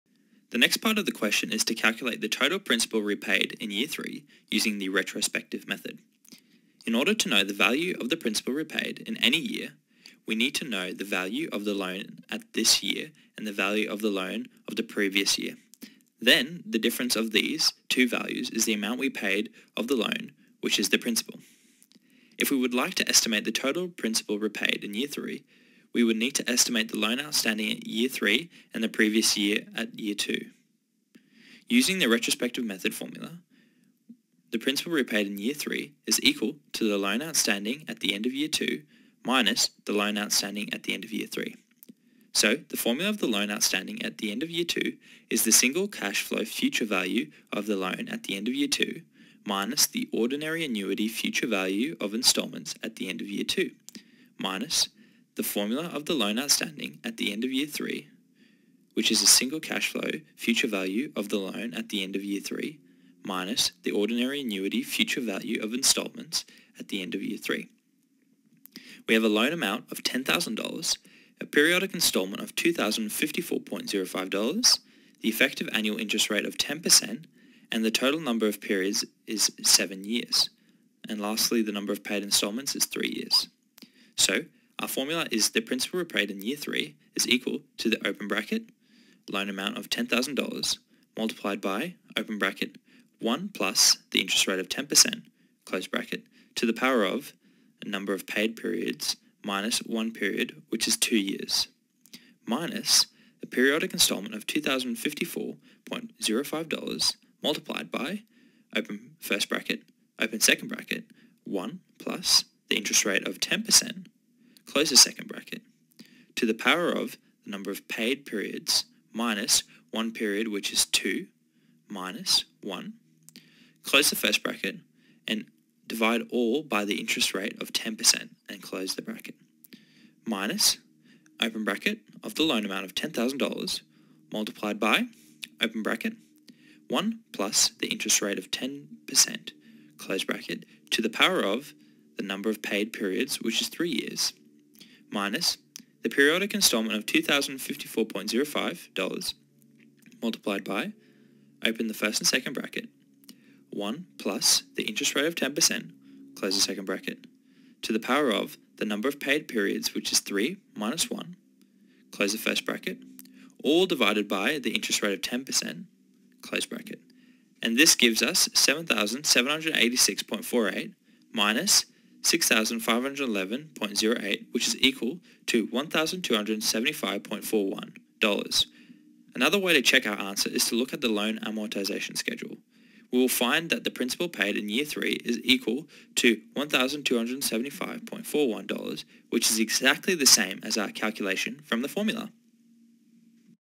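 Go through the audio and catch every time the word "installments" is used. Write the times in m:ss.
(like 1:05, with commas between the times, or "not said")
0:52, 1:05, 1:11, 1:22, 1:43, 2:26.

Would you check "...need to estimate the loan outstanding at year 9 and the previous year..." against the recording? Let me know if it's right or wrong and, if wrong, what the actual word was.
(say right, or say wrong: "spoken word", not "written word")
wrong: "3", not "9".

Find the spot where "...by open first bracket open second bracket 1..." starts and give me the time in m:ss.
1:47.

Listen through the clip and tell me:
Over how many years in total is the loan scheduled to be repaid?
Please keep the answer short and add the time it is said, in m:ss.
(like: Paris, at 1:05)
7 years, at 1:19.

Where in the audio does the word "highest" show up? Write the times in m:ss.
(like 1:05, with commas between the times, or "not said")
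not said.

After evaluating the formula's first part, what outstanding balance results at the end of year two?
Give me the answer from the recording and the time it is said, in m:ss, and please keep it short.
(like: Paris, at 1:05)
7,786.48, at 2:48.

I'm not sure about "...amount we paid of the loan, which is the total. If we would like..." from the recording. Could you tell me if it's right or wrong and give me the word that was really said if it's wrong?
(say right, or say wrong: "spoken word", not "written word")
wrong: "principal", not "total".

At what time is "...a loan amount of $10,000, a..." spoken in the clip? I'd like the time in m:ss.
1:09.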